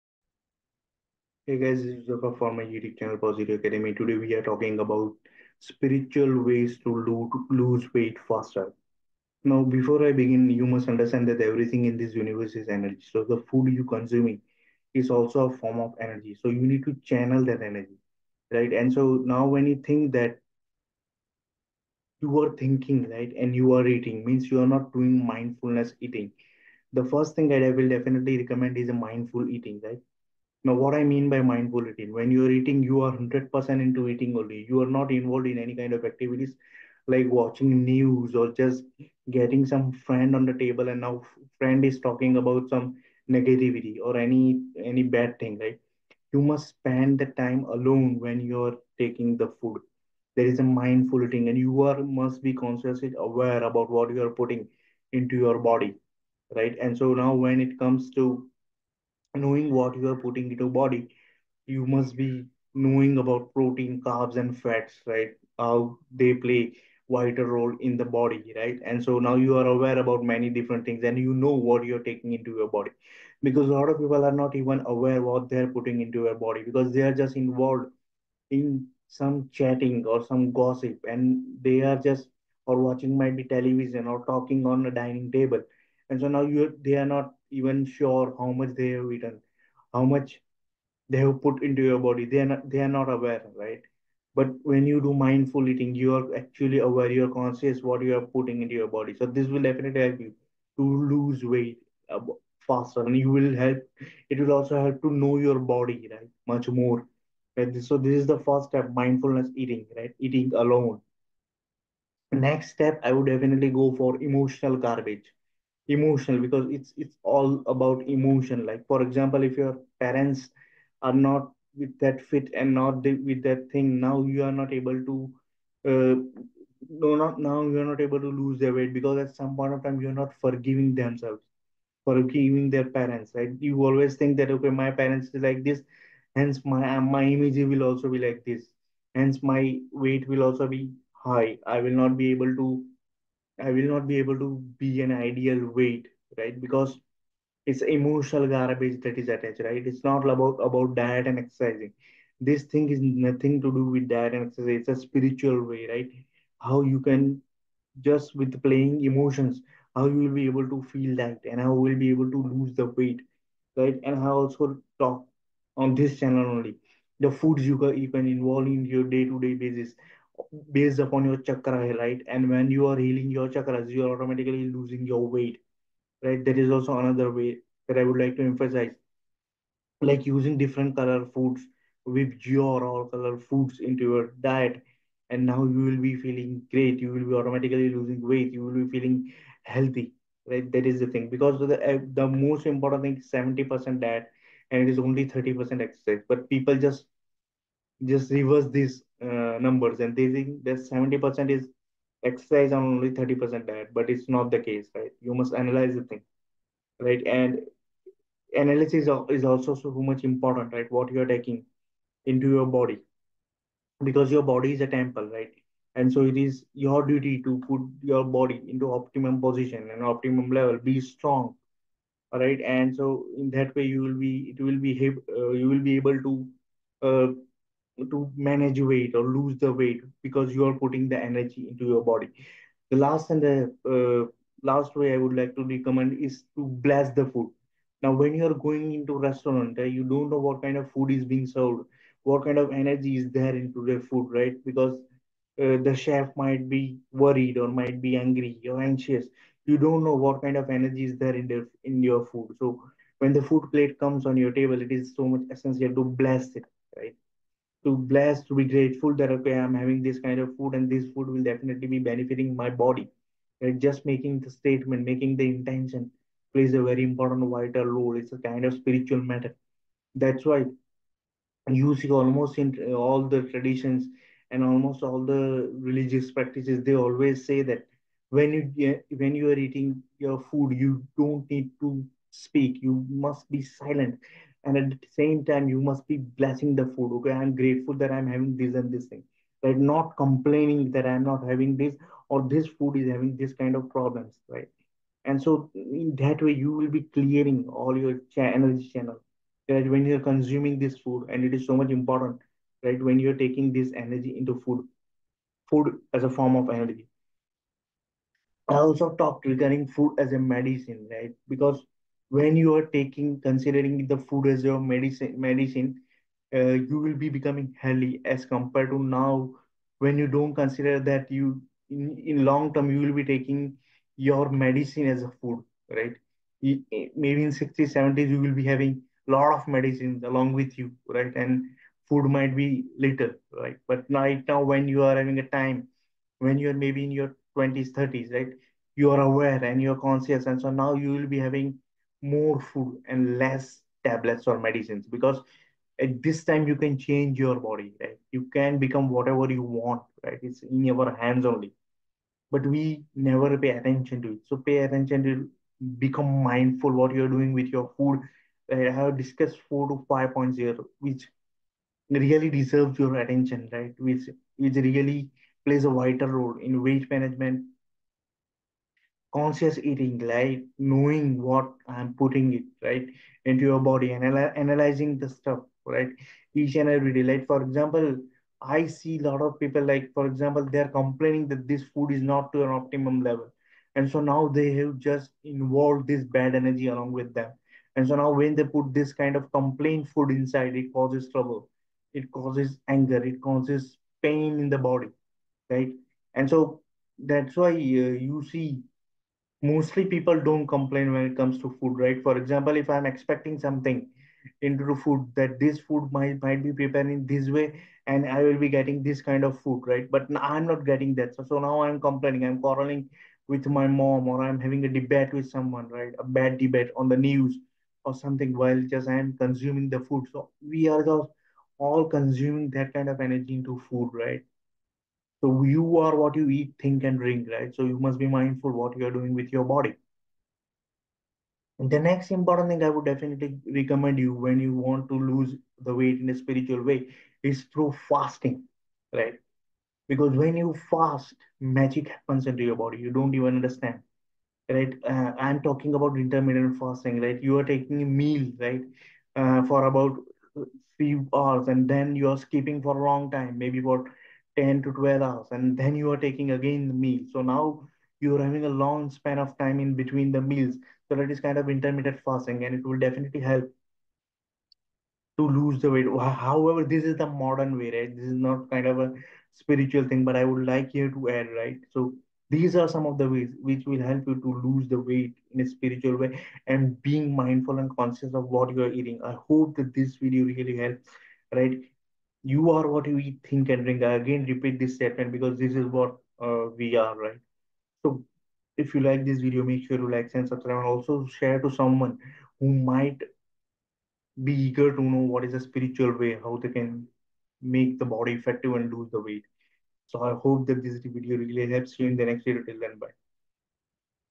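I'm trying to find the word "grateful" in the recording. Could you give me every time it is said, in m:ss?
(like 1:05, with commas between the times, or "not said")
4:18, 4:47.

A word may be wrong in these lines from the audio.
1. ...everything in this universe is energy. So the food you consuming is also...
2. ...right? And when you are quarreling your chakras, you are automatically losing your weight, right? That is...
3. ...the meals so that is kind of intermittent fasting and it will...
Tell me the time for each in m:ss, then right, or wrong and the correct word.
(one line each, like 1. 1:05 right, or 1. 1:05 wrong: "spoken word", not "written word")
1. 0:11 right
2. 2:51 wrong: "healing", not "quarreling"
3. 7:40 right.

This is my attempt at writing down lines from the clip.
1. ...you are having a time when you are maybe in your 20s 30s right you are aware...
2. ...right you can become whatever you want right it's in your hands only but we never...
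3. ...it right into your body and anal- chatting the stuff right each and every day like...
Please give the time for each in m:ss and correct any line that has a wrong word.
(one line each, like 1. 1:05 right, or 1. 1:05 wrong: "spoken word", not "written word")
1. 5:34 right
2. 5:47 right
3. 6:12 wrong: "analyzing", not "chatting".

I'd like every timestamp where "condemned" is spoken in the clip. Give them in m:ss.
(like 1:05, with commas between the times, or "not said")
not said.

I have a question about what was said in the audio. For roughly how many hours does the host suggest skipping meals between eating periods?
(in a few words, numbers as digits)
10 to 12 hours.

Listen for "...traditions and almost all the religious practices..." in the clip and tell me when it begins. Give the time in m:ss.
4:33.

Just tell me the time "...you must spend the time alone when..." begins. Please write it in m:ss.
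0:46.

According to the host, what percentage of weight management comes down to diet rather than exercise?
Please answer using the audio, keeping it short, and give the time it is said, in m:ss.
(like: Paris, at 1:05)
70%, at 3:13.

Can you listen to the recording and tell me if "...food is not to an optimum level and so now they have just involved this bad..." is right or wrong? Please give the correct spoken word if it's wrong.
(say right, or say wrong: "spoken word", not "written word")
right.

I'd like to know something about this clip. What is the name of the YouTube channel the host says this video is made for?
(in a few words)
Positive Academy.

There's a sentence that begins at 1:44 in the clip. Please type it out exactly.
It will also help to know your body, right, much more.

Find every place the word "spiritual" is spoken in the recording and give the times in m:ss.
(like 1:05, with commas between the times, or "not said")
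0:05, 2:35, 4:28, 7:16, 7:49, 7:55, 8:15.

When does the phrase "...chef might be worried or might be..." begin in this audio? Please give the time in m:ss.
4:05.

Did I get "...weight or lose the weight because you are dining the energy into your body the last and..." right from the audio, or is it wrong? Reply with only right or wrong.
wrong.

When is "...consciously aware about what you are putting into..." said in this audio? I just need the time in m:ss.
0:52.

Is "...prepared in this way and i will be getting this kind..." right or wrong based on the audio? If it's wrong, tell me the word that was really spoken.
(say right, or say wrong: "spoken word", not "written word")
right.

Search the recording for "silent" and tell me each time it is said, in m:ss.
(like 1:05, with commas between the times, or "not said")
4:43.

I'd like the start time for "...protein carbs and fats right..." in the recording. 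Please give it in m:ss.
1:03.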